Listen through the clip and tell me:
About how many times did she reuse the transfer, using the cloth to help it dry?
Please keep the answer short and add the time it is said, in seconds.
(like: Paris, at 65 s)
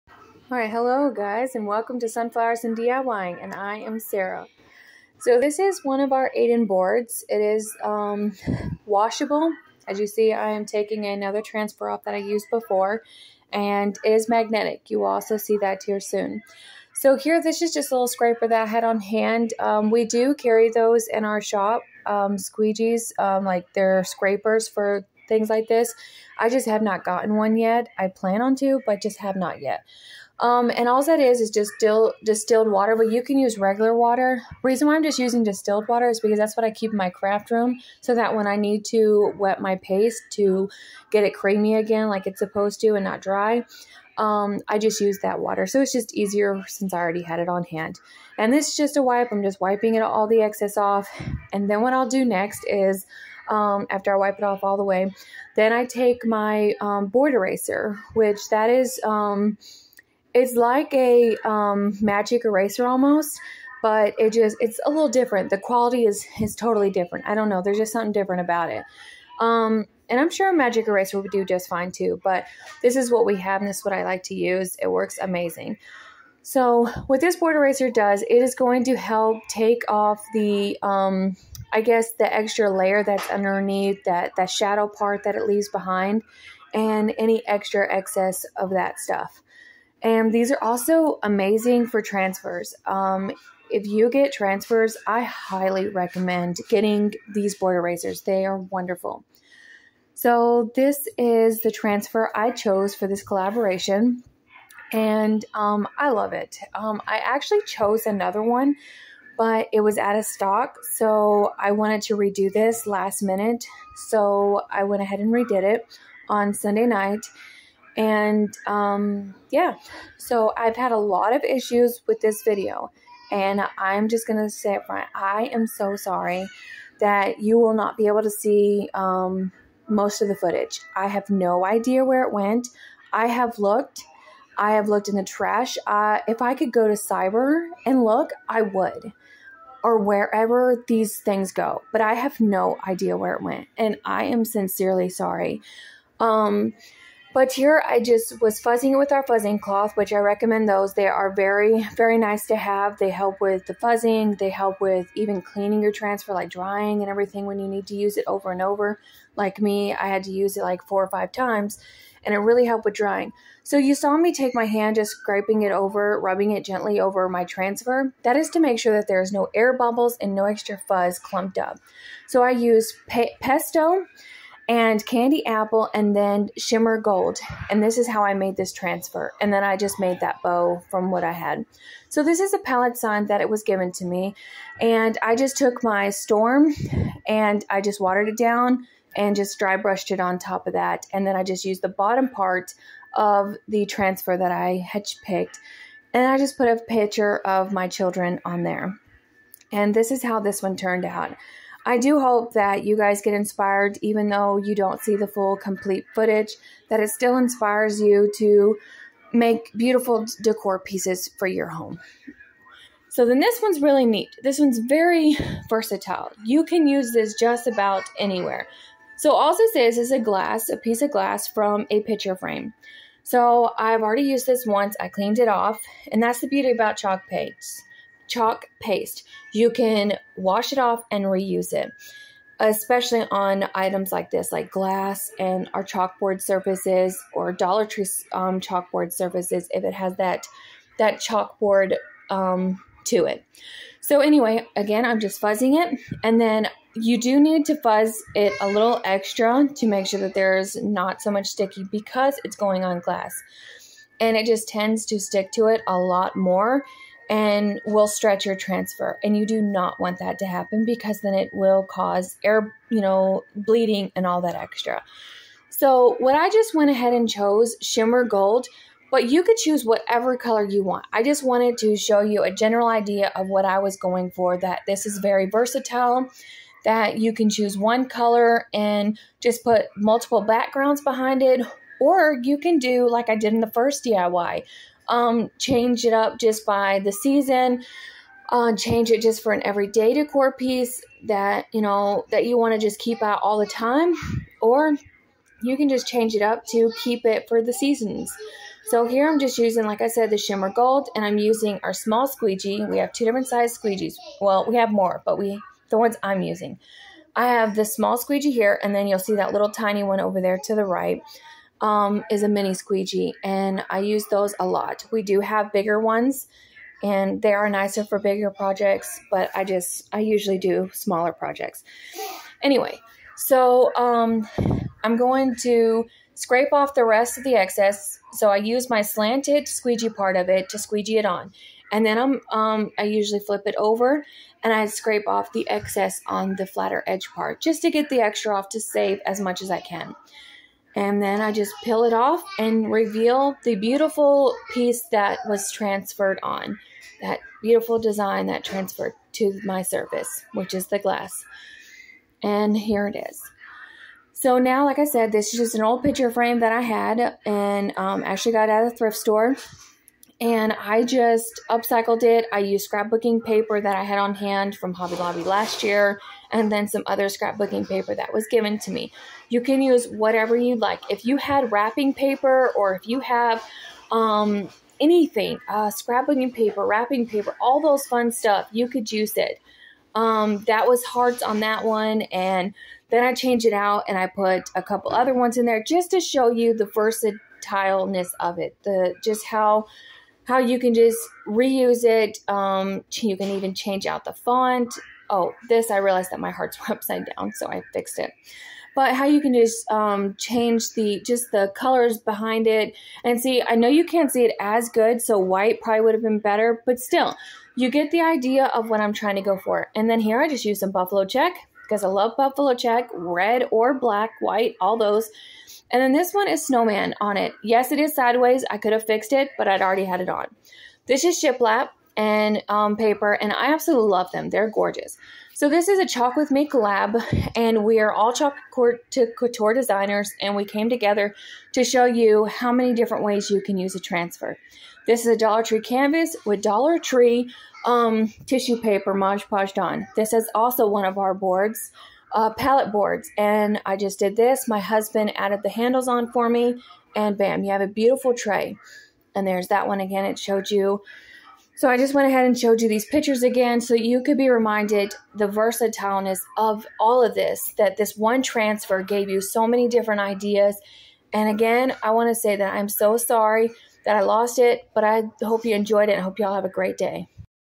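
4 or 5, at 160 s.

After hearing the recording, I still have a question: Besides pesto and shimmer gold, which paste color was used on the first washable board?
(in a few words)
Candy apple.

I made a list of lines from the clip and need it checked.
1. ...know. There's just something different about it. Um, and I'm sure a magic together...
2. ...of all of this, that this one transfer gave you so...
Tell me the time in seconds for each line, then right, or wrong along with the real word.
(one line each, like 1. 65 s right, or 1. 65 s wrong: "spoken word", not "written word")
1. 67 s wrong: "eraser", not "together"
2. 456 s right.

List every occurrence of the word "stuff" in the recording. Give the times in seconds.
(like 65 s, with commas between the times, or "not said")
88 s, 378 s.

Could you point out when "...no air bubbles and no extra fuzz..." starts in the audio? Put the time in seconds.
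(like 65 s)
169 s.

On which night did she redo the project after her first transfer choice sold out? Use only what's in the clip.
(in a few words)
Sunday.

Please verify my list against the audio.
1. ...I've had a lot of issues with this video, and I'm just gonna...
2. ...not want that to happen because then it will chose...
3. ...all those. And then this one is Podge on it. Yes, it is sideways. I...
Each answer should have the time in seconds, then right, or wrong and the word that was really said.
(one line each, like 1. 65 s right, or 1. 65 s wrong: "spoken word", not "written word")
1. 120 s right
2. 259 s wrong: "cause", not "chose"
3. 414 s wrong: "Snowman", not "Podge".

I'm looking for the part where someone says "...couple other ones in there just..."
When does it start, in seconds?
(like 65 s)
384 s.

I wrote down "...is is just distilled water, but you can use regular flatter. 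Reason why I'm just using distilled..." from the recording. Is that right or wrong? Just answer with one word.
wrong.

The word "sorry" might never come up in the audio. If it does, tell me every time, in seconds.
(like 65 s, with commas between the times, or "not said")
125 s, 145 s, 463 s.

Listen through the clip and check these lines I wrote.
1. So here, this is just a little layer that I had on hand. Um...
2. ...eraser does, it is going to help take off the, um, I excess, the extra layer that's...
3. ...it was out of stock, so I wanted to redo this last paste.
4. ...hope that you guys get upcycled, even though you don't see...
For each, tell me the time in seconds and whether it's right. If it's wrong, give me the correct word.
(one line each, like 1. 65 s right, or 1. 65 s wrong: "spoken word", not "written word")
1. 16 s wrong: "scraper", not "layer"
2. 77 s wrong: "guess", not "excess"
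3. 109 s wrong: "minute", not "paste"
4. 202 s wrong: "inspired", not "upcycled".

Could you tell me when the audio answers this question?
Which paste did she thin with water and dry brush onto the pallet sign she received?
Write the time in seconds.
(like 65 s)
186 s.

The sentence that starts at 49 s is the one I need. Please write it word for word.
I'm just wiping it all the excess off.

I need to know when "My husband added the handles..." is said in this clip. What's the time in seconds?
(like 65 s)
444 s.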